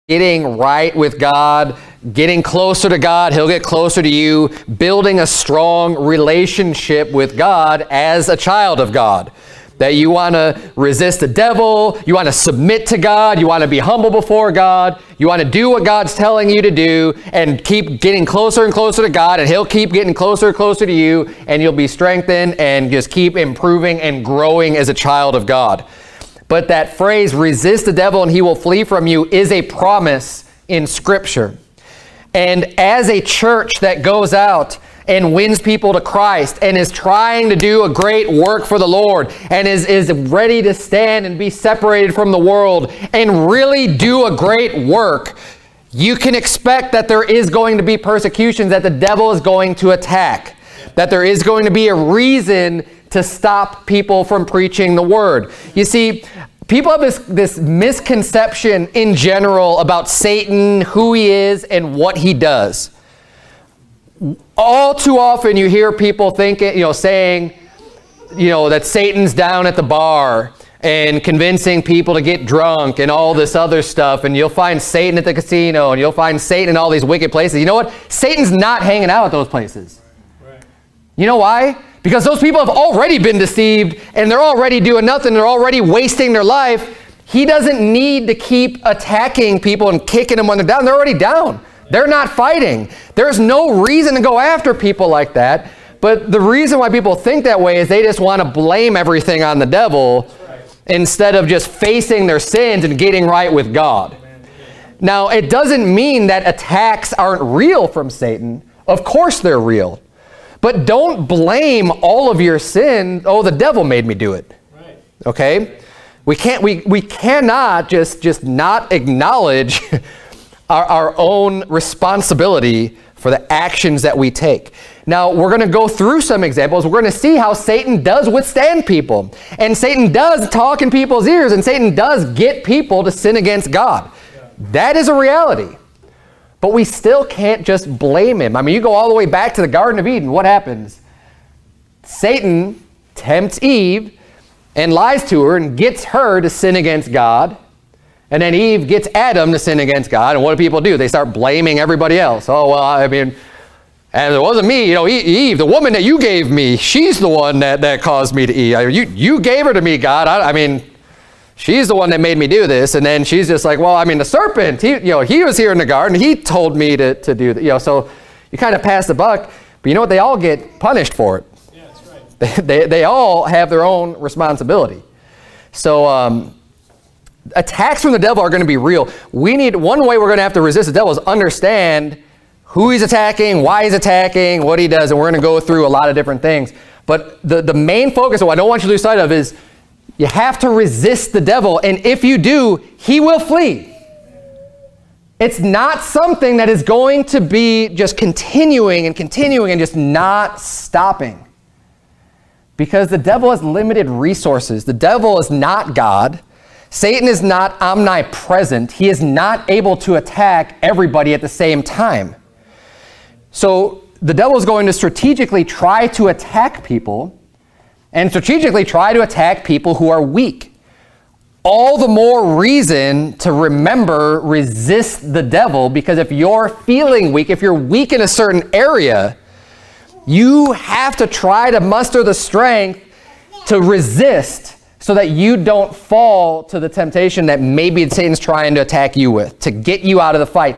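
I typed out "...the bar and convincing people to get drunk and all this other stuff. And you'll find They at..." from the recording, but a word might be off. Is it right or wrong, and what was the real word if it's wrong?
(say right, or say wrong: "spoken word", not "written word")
wrong: "Satan", not "They".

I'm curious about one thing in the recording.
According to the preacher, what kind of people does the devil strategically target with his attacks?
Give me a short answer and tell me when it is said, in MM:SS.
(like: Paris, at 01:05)
people who are weak, at 03:39.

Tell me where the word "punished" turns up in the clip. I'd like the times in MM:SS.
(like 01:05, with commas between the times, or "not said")
02:50.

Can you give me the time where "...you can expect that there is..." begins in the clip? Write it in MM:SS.
00:45.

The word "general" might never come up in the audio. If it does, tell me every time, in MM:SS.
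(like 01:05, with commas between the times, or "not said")
00:59.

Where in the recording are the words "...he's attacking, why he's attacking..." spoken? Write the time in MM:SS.
03:02.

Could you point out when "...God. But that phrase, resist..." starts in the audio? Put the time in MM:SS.
00:25.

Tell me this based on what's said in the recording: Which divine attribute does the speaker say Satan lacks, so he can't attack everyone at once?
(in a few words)
omnipresent.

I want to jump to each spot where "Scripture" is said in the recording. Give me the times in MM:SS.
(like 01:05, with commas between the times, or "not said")
00:30.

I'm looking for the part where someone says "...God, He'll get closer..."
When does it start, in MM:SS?
00:02.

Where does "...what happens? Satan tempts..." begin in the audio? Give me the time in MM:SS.
02:20.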